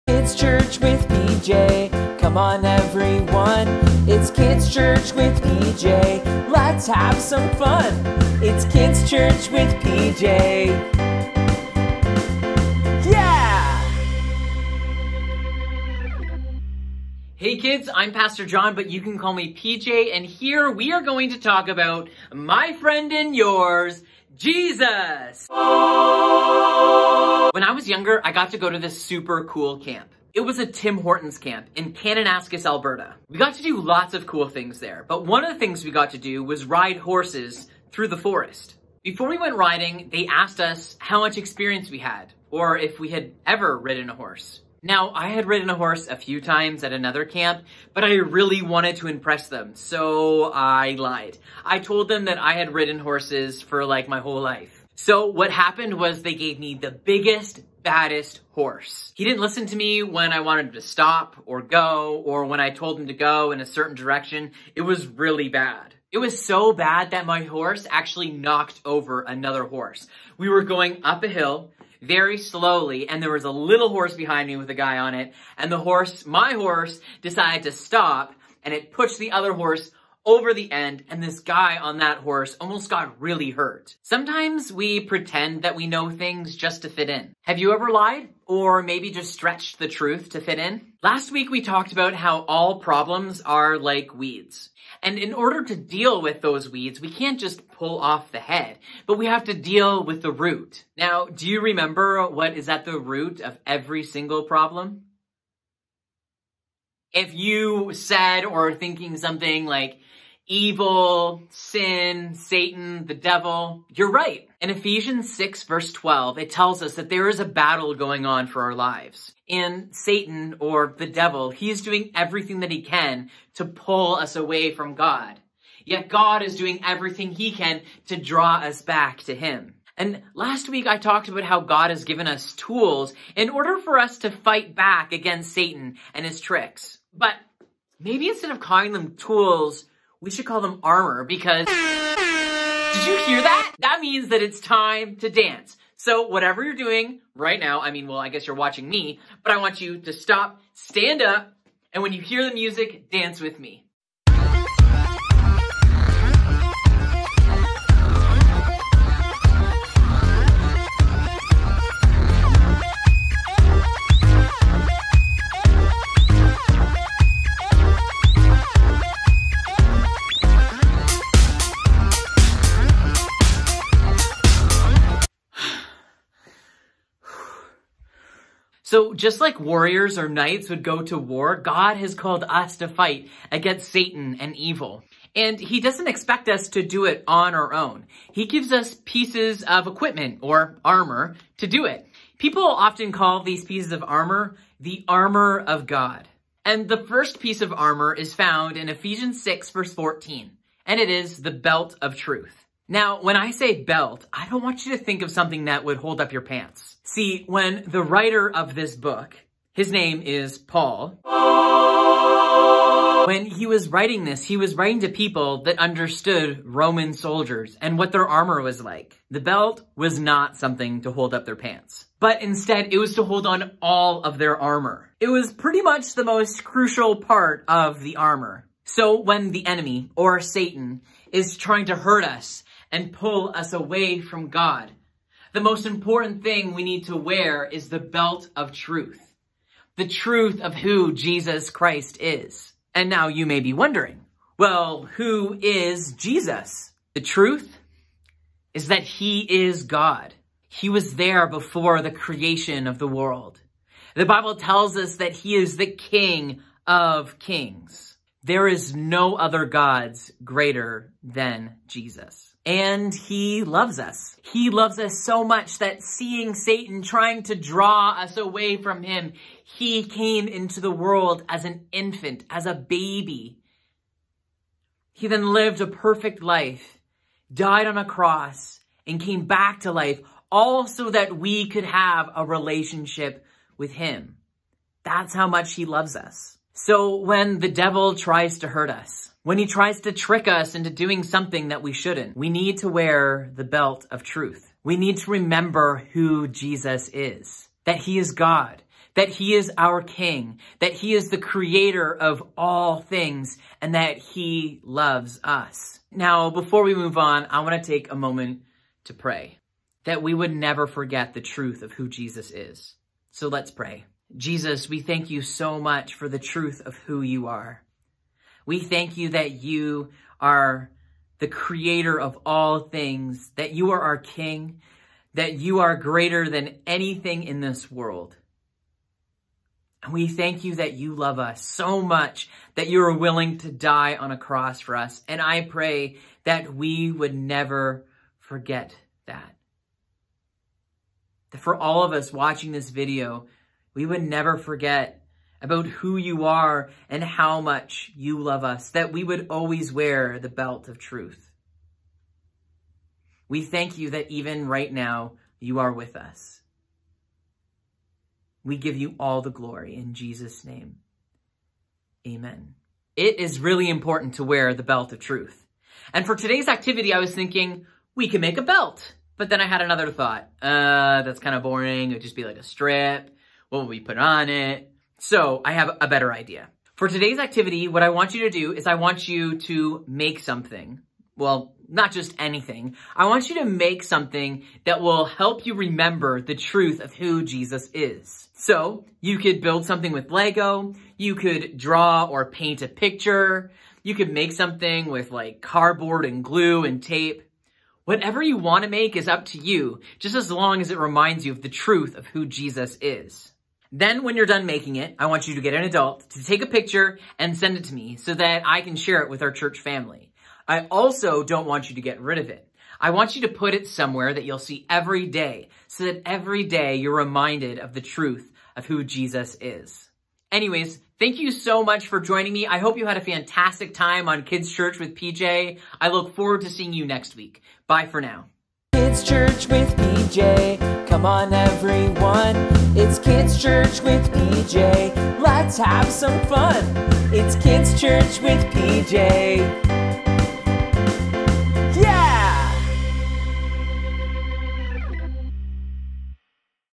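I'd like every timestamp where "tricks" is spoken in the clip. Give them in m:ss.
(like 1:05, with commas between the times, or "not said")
2:16, 4:50.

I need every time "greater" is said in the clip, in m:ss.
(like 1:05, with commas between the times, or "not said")
4:20, 5:25.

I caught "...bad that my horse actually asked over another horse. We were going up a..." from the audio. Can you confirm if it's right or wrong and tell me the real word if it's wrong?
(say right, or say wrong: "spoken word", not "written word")
wrong: "knocked", not "asked".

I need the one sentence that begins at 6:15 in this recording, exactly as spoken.
So I have a better idea.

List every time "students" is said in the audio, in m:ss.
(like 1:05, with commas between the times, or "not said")
not said.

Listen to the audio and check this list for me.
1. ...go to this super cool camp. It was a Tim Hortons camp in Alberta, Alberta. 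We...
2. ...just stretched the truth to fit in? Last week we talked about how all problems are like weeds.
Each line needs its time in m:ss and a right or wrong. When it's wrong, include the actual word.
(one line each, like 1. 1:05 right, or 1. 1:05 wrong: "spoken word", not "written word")
1. 0:28 wrong: "Kananaskis", not "Alberta"
2. 1:29 right.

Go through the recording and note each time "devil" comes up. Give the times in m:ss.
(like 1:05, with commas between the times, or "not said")
1:53, 2:01, 4:47.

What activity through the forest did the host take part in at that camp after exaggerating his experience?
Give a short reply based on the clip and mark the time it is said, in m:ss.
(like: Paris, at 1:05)
Ride horses, at 0:36.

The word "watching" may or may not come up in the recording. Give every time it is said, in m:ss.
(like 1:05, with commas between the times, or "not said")
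2:28, 5:42.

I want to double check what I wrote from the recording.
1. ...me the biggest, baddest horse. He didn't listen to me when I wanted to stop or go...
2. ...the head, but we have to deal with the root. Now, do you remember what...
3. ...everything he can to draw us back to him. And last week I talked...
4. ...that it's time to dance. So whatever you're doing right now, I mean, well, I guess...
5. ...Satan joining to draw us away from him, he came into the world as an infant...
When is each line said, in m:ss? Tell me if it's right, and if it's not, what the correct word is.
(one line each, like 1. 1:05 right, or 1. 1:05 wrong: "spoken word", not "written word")
1. 0:56 right
2. 1:38 right
3. 2:06 right
4. 2:24 right
5. 4:26 wrong: "trying", not "joining".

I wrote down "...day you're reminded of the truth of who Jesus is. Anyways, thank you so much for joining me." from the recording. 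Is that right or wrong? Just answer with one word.
right.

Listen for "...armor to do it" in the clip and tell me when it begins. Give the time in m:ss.
3:10.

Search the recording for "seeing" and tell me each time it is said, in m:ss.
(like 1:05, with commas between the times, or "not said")
4:26, 7:06.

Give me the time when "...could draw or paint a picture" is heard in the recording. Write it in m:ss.
6:31.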